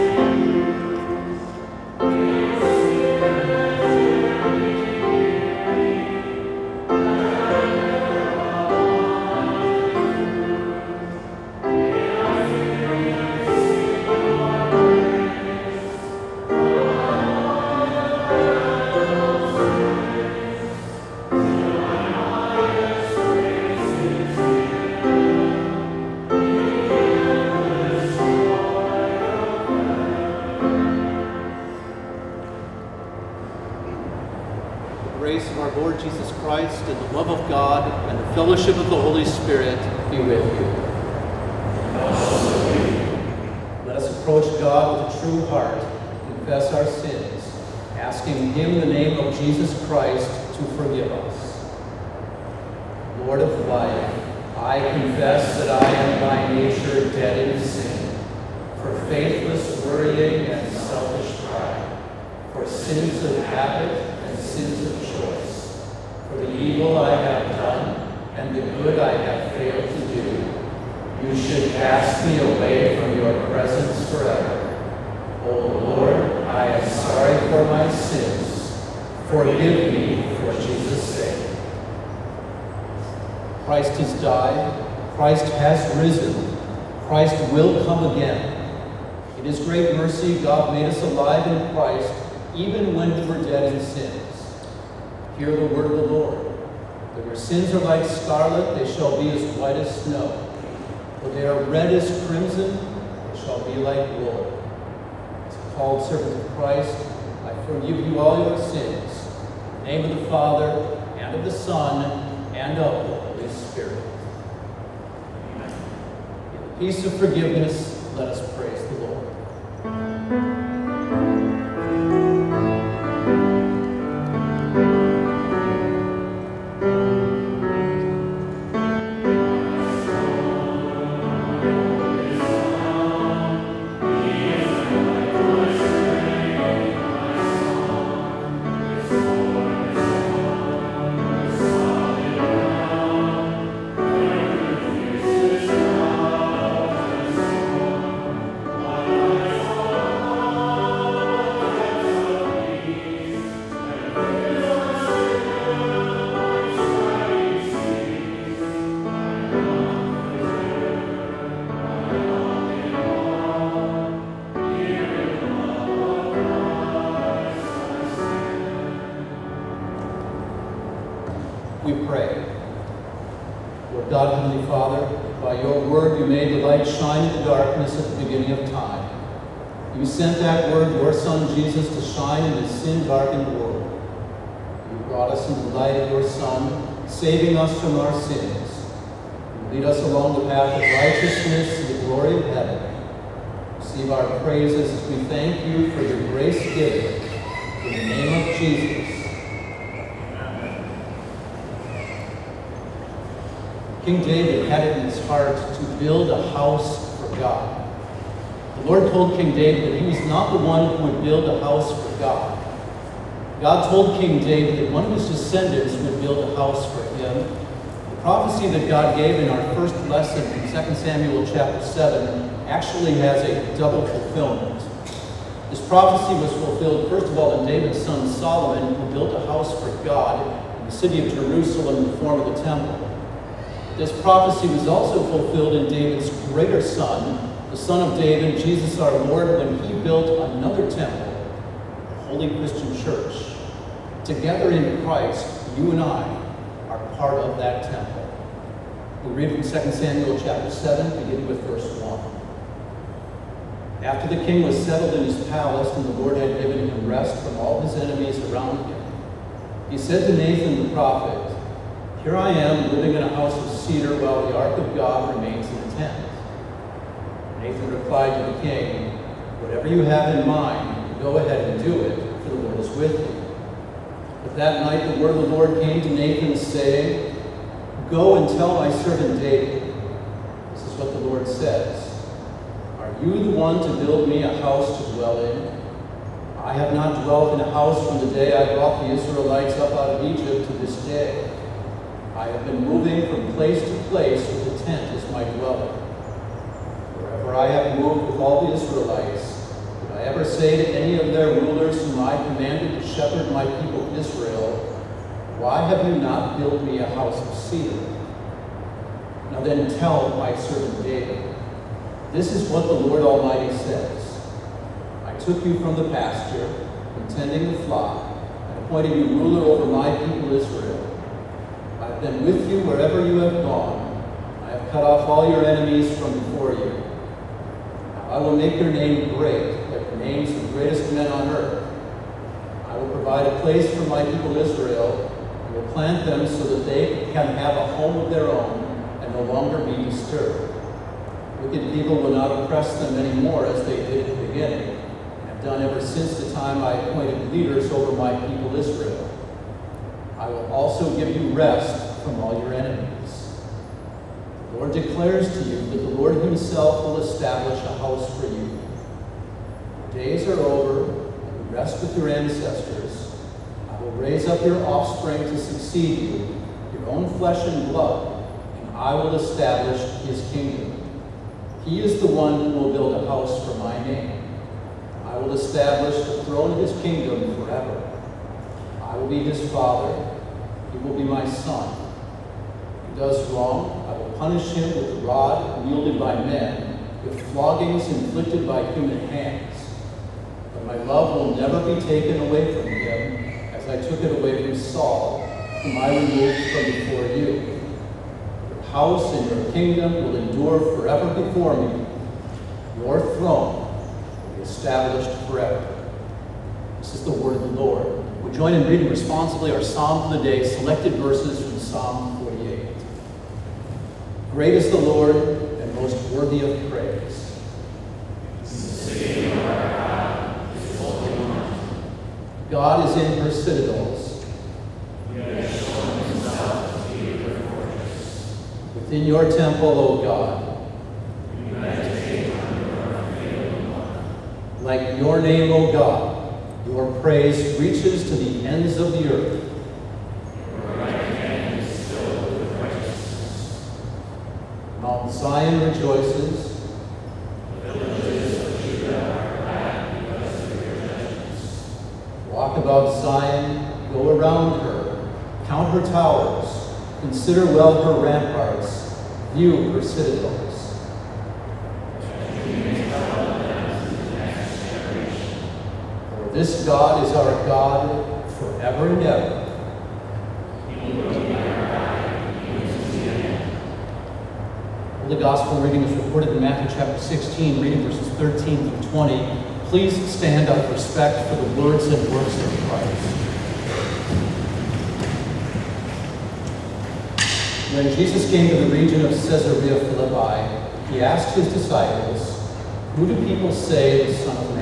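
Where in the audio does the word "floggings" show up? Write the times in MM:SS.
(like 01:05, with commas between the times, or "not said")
06:27.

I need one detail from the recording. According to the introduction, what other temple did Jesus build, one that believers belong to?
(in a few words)
The Holy Christian Church.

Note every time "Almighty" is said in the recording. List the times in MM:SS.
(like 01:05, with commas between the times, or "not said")
05:13.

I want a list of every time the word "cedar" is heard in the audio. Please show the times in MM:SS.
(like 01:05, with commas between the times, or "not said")
04:23, 05:07.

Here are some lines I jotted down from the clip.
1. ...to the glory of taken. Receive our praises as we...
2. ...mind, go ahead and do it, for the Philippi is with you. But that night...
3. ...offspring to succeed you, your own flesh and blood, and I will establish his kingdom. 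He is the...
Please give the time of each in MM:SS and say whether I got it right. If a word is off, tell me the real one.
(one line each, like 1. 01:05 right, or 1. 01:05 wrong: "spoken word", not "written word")
1. 03:11 wrong: "heaven", not "taken"
2. 04:30 wrong: "Lord", not "Philippi"
3. 06:04 right.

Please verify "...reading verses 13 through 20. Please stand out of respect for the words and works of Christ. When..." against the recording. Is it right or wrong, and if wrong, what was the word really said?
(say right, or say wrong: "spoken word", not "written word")
right.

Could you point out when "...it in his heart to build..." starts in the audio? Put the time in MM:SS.
03:24.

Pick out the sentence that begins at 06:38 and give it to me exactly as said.
Your house and your kingdom will endure forever before me.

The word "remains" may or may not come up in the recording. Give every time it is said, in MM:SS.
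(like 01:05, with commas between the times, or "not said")
04:25.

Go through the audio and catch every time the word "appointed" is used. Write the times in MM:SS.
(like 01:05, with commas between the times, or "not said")
05:18, 05:46.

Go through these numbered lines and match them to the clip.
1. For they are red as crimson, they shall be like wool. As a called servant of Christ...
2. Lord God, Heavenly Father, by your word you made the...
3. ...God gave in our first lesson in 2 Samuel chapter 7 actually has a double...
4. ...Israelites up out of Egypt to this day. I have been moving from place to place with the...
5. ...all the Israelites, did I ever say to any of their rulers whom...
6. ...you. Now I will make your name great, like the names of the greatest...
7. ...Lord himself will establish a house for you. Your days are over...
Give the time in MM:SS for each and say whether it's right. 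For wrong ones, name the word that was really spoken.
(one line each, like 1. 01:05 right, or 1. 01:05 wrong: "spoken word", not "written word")
1. 01:41 right
2. 02:53 right
3. 03:38 right
4. 04:49 right
5. 04:58 right
6. 05:26 right
7. 05:56 right.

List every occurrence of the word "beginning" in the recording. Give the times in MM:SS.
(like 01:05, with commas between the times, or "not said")
02:58, 04:11, 05:44.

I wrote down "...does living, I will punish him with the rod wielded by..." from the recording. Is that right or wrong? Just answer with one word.
wrong.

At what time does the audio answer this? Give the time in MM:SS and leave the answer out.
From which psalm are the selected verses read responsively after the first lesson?
06:51.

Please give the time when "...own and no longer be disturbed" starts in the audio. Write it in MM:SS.
05:38.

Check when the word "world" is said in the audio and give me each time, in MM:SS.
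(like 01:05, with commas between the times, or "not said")
03:03.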